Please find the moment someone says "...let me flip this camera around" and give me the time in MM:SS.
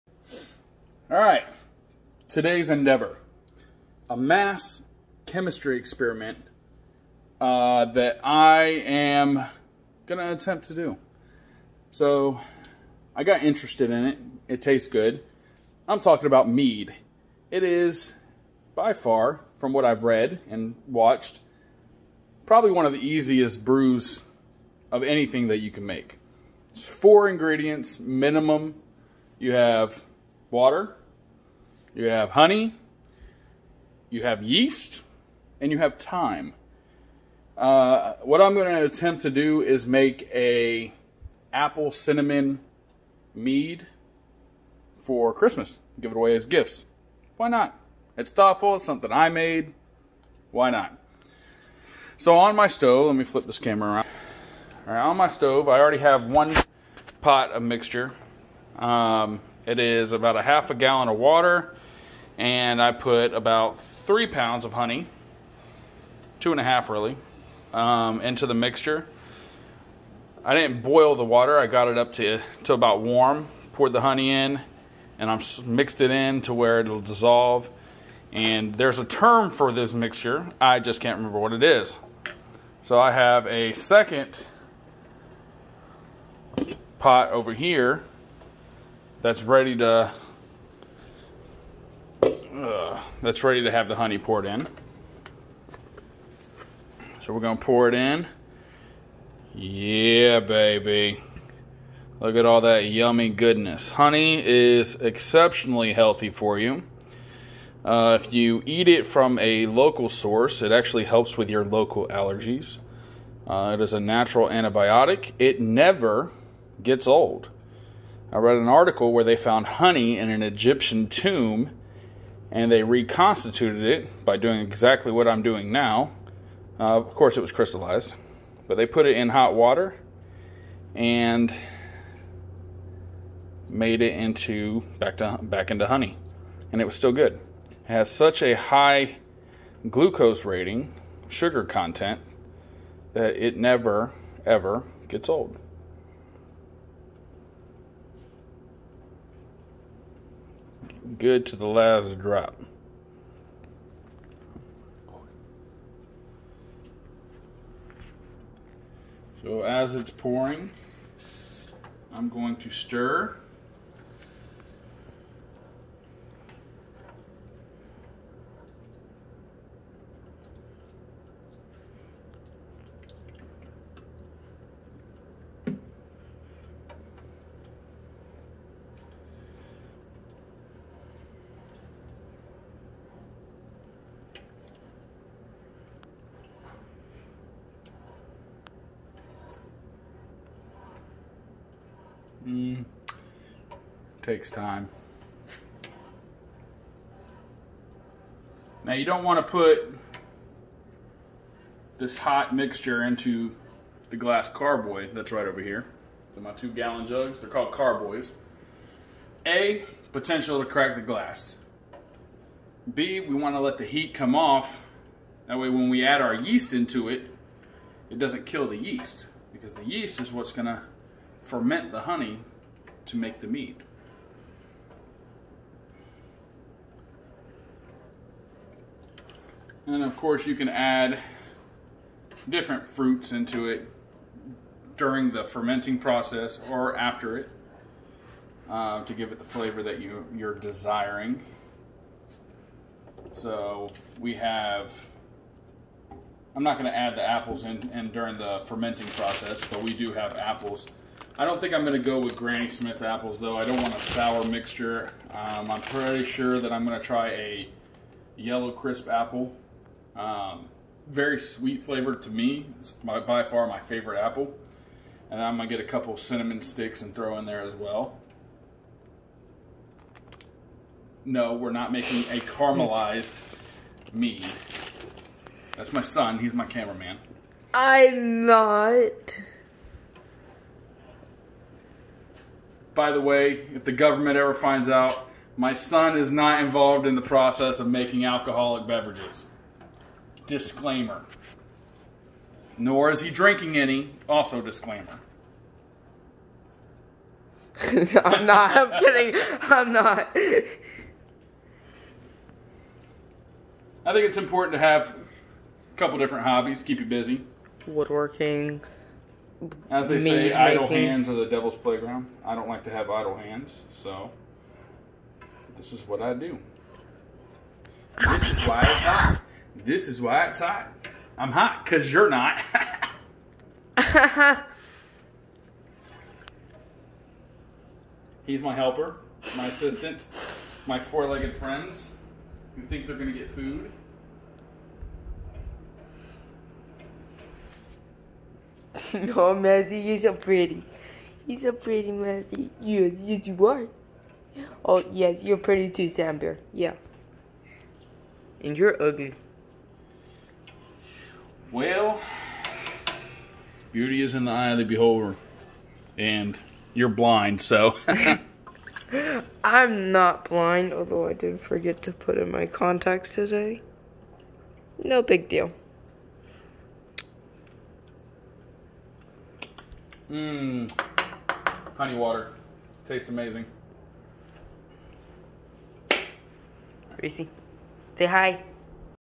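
00:53.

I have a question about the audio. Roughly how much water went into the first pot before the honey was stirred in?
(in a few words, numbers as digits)
half a gallon.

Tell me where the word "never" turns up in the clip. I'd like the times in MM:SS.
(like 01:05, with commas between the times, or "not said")
01:55, 02:23.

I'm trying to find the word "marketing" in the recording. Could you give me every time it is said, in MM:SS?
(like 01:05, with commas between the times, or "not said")
not said.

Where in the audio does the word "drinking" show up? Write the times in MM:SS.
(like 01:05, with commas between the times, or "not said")
04:53.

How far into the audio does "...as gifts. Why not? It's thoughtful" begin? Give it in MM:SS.
00:46.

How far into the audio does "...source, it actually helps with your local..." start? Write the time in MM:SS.
01:50.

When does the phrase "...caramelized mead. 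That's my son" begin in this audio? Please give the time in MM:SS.
04:32.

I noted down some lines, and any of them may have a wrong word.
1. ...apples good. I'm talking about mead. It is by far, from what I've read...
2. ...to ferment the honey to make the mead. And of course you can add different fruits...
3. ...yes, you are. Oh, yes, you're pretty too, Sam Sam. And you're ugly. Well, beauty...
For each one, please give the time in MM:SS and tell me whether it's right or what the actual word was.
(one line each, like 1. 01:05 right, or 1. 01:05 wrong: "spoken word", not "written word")
1. 00:14 wrong: "tastes", not "apples"
2. 03:40 right
3. 05:43 wrong: "Yeah", not "Sam".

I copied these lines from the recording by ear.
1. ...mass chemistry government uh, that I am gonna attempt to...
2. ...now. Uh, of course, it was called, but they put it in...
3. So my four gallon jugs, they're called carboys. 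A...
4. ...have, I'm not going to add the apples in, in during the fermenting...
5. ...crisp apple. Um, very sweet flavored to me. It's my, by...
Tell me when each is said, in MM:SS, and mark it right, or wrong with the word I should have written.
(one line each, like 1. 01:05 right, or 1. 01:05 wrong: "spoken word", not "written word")
1. 00:04 wrong: "experiment", not "government"
2. 02:05 wrong: "crystallized", not "called"
3. 03:26 wrong: "two", not "four"
4. 04:04 right
5. 04:18 right.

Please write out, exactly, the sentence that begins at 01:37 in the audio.
So we're gonna pour it in.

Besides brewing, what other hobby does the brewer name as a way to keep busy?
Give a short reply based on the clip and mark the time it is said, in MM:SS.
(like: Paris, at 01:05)
Woodworking, at 05:07.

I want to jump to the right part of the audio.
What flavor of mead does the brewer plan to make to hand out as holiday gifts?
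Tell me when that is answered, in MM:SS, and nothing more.
00:41.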